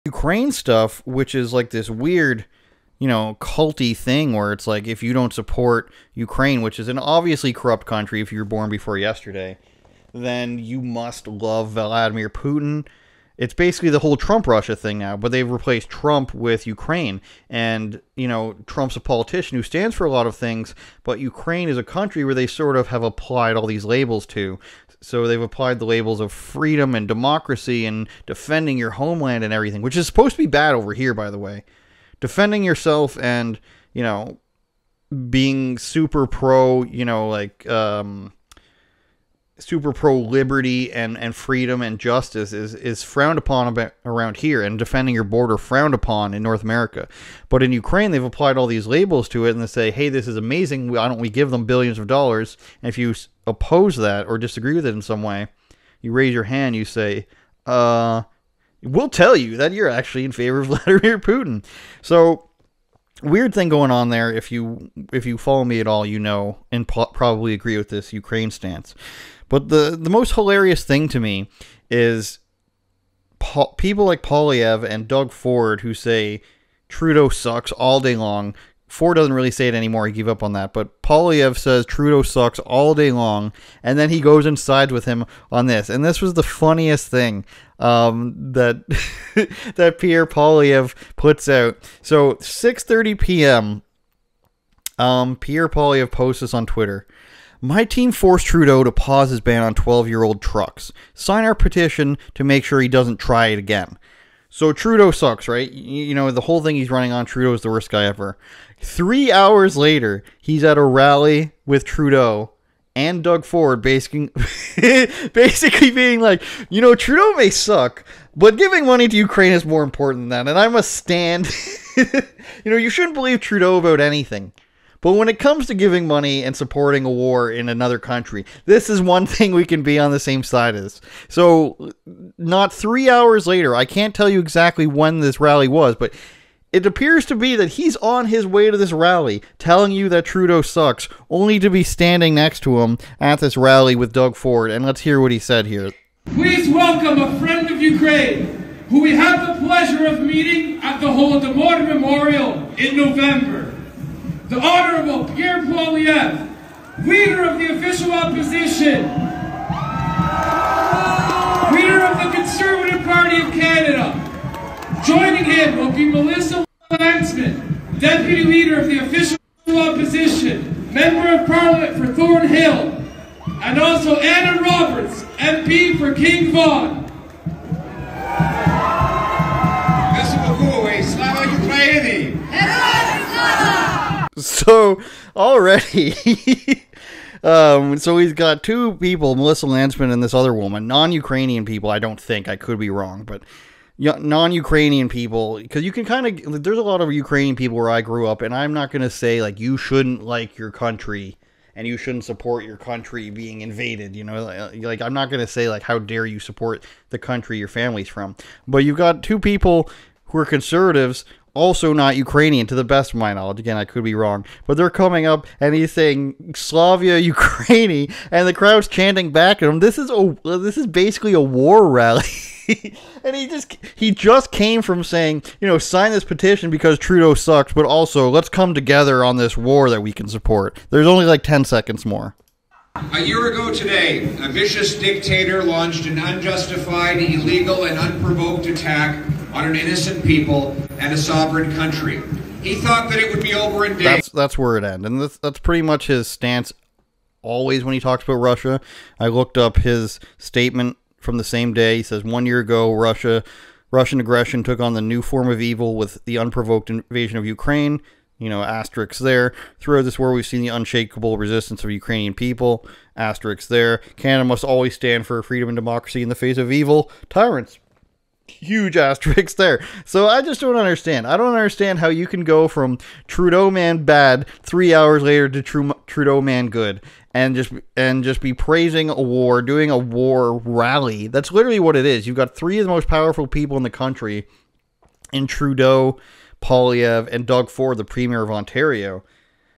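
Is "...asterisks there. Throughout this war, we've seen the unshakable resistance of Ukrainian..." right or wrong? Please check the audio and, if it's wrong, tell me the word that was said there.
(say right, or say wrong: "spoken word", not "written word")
right.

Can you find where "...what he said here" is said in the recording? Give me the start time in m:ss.
2:25.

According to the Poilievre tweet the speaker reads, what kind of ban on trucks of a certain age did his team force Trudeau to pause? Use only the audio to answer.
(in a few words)
12 year old trucks.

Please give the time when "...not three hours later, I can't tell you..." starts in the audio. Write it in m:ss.
2:12.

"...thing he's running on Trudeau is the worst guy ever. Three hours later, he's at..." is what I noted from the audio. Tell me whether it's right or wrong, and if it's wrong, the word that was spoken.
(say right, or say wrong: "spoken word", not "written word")
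right.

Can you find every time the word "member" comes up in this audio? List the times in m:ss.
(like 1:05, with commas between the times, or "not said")
2:50.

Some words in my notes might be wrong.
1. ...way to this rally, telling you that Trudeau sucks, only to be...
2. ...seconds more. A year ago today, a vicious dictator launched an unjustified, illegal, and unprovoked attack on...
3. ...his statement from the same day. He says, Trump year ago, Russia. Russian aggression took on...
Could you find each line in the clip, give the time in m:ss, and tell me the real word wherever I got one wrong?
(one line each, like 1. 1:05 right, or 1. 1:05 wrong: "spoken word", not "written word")
1. 2:18 right
2. 3:51 right
3. 4:09 wrong: "One", not "Trump".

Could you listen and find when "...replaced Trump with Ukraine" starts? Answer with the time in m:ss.
0:15.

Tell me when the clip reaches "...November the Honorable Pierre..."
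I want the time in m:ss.
2:32.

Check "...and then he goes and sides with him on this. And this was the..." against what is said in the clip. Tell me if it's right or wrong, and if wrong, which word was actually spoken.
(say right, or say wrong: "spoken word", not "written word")
right.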